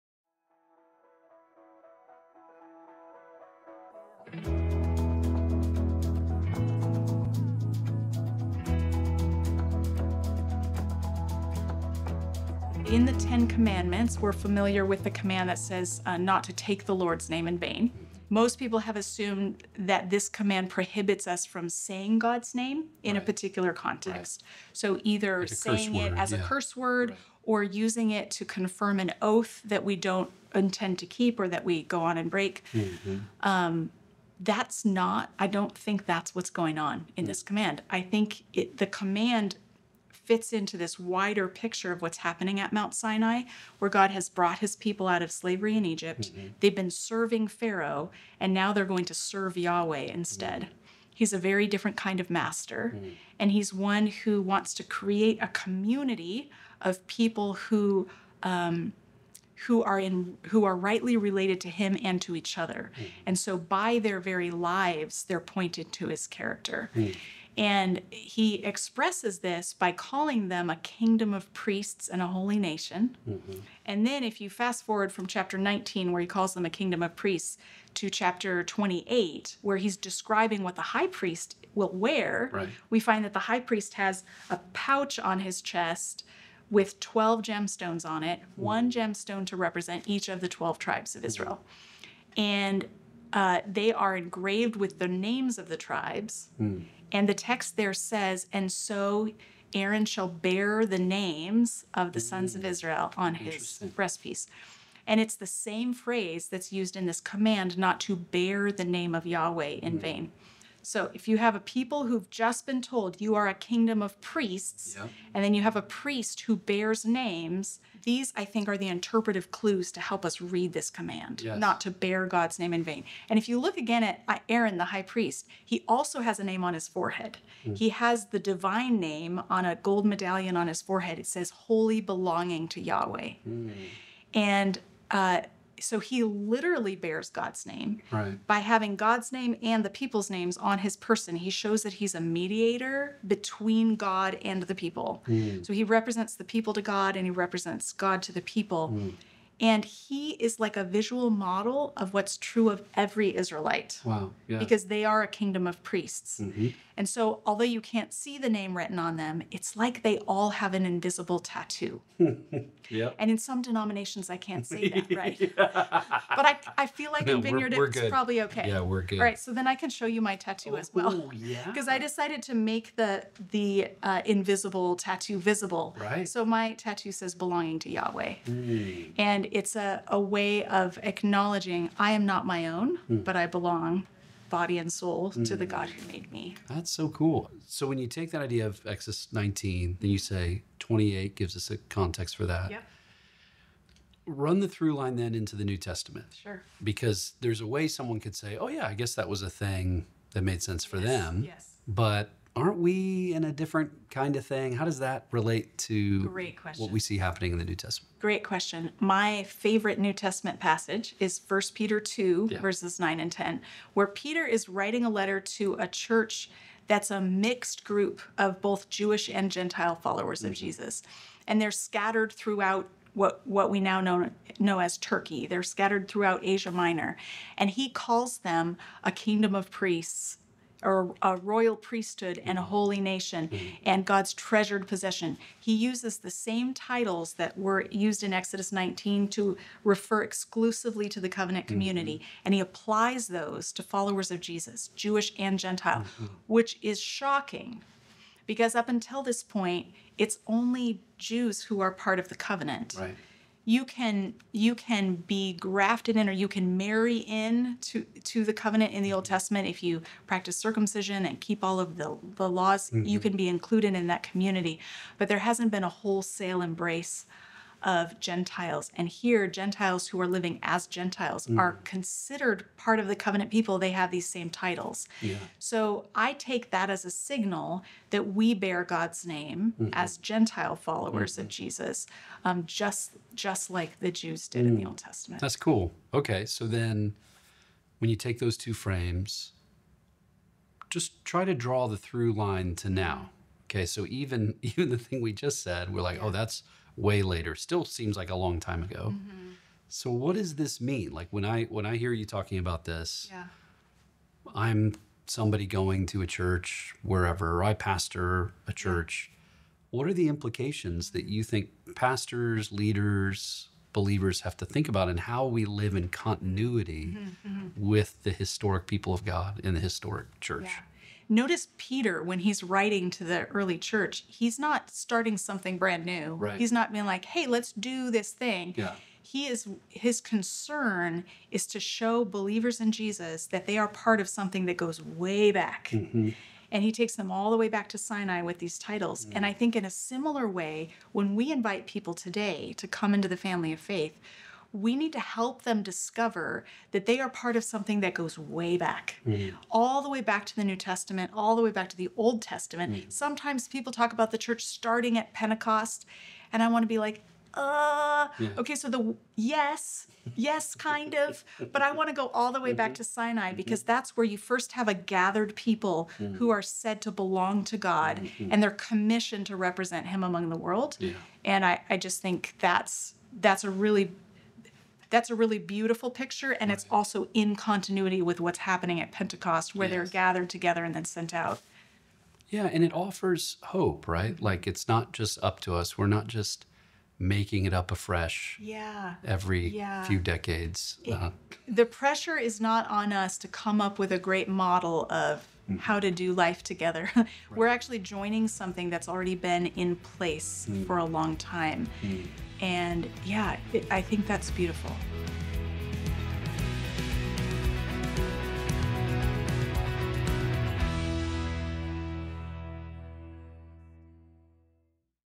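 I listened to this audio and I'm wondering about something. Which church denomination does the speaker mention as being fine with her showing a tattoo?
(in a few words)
Vineyard.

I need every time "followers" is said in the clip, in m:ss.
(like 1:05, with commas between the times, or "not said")
3:39, 4:03, 4:40.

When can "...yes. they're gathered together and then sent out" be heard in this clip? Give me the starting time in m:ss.
6:19.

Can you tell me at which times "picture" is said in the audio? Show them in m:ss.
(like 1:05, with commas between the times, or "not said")
0:41, 6:16.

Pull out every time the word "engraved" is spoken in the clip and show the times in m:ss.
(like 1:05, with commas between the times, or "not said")
1:34.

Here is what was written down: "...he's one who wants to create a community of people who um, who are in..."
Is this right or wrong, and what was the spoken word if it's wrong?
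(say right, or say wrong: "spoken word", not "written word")
right.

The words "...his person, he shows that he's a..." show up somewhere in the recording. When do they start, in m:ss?
2:20.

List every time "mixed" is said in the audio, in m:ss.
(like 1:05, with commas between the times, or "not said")
3:37.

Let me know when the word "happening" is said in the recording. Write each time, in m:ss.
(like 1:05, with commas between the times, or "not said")
0:42, 3:27, 6:18.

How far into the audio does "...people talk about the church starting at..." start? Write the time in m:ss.
5:53.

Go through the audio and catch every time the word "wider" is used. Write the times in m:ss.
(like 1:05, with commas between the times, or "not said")
0:40.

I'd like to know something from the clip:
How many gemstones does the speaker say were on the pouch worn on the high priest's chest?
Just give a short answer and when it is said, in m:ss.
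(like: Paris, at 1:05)
12, at 1:27.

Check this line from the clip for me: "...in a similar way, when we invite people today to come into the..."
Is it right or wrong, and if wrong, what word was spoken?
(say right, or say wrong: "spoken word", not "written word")
right.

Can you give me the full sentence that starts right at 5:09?
What are the implications that you think pastors, leaders, believers have to think about and how we live in continuity mm-hmm.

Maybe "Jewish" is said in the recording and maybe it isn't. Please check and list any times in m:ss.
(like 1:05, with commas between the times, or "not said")
3:38, 4:04.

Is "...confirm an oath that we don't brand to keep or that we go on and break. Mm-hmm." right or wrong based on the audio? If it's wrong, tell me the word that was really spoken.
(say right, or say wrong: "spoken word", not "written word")
wrong: "intend", not "brand".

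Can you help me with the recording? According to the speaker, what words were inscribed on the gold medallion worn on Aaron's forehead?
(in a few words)
Holy Belonging to Yahweh.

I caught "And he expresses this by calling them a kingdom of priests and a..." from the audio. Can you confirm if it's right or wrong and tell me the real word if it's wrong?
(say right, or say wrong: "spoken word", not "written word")
right.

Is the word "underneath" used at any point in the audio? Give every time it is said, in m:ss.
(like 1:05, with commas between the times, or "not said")
not said.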